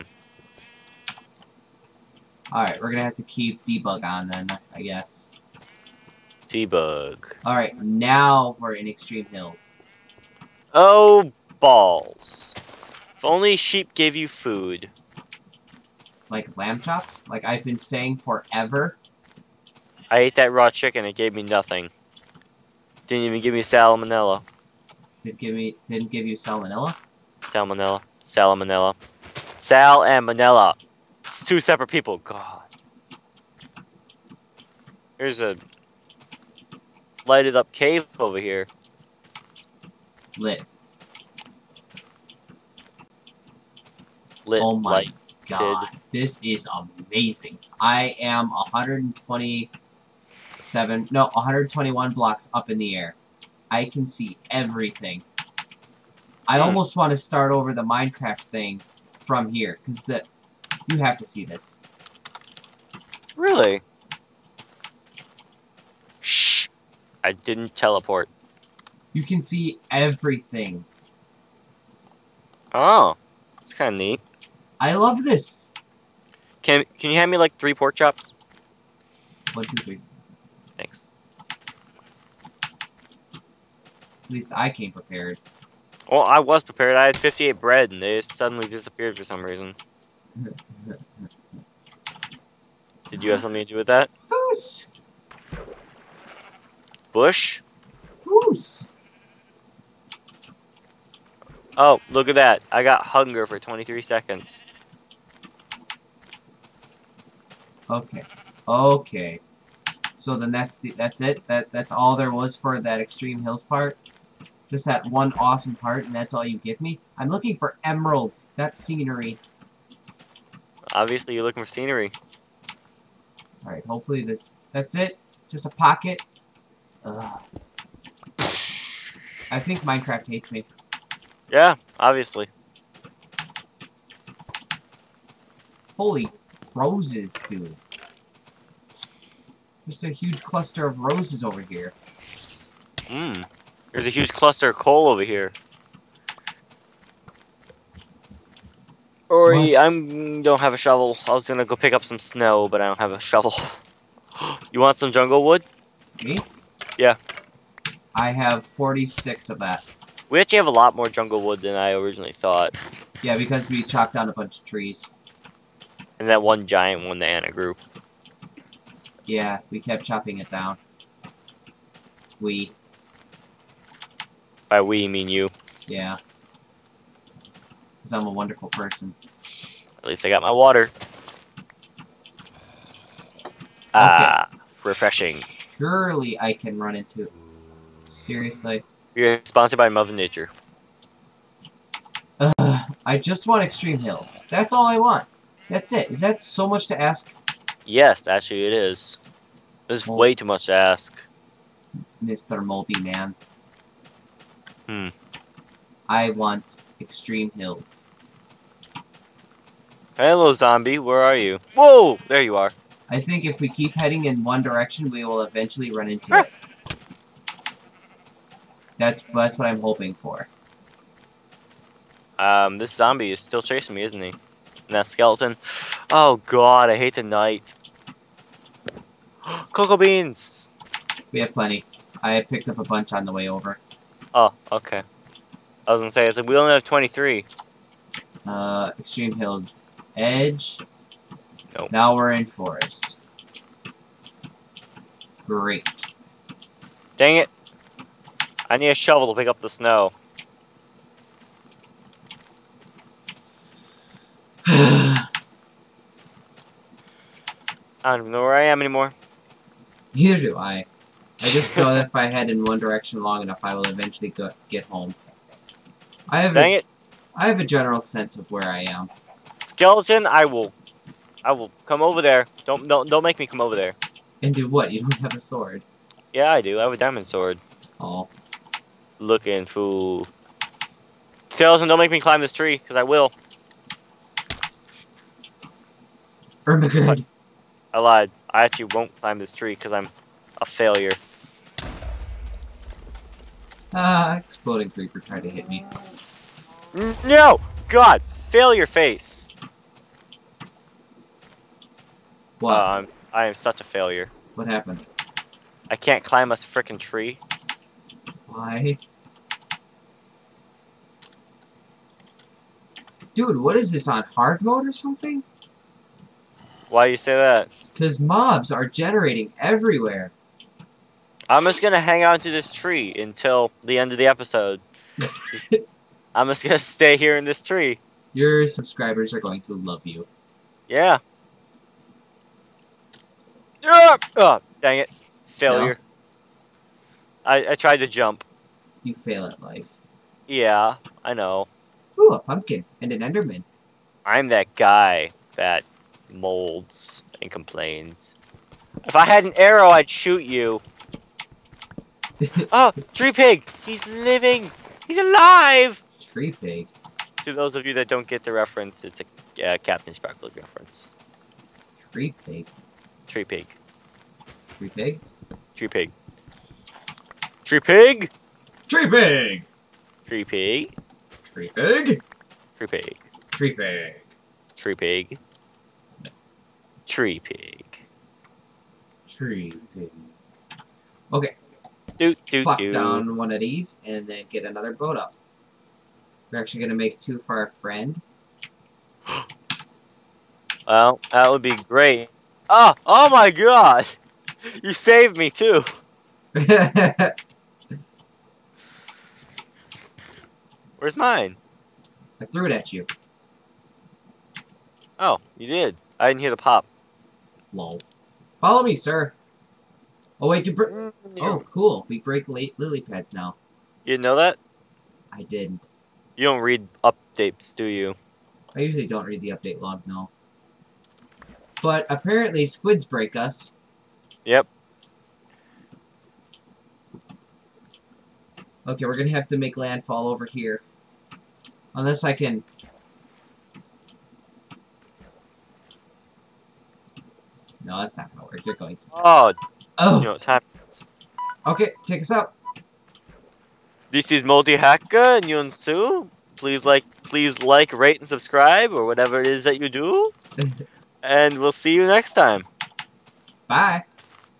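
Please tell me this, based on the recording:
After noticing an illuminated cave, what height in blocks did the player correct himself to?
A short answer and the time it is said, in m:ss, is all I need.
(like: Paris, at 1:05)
121, at 0:51.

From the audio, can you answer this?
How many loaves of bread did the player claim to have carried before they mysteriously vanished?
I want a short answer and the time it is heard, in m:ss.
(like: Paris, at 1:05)
58, at 1:27.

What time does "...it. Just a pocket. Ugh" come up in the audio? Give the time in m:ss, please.
2:04.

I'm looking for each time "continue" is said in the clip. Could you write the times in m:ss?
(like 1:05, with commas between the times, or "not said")
not said.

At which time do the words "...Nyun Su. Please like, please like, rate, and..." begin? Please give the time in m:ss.
7:25.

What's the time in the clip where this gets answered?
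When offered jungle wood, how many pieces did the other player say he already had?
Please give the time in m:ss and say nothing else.
2:38.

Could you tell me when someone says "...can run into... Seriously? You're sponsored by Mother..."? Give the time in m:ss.
3:06.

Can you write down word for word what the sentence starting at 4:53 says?
Ah, exploding creeper tried to hit me.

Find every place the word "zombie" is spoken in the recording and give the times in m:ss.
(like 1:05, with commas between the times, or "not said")
3:30, 3:42.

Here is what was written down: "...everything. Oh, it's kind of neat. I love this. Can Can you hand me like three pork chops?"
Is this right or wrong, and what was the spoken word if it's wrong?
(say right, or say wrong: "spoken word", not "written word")
right.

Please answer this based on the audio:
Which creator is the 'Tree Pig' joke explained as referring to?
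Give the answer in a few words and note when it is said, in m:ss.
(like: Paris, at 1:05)
Captain Sparkle, at 5:59.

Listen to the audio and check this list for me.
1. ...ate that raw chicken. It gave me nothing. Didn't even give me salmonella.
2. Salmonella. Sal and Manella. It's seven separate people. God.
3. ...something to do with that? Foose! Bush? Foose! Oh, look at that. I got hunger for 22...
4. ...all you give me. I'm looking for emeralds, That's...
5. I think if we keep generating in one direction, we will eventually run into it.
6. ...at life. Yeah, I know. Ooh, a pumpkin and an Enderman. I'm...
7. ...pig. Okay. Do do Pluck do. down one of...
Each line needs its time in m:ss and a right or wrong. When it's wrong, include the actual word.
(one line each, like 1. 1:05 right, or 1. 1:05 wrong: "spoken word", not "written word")
1. 0:20 right
2. 0:28 wrong: "two", not "seven"
3. 1:33 wrong: "23", not "22"
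4. 1:56 right
5. 3:33 wrong: "heading", not "generating"
6. 5:39 right
7. 6:19 right.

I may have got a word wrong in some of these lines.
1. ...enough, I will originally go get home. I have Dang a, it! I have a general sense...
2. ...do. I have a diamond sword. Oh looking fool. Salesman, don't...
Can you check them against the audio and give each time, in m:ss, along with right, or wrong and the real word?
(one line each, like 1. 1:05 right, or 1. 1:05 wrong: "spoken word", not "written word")
1. 4:23 wrong: "eventually", not "originally"
2. 4:36 right.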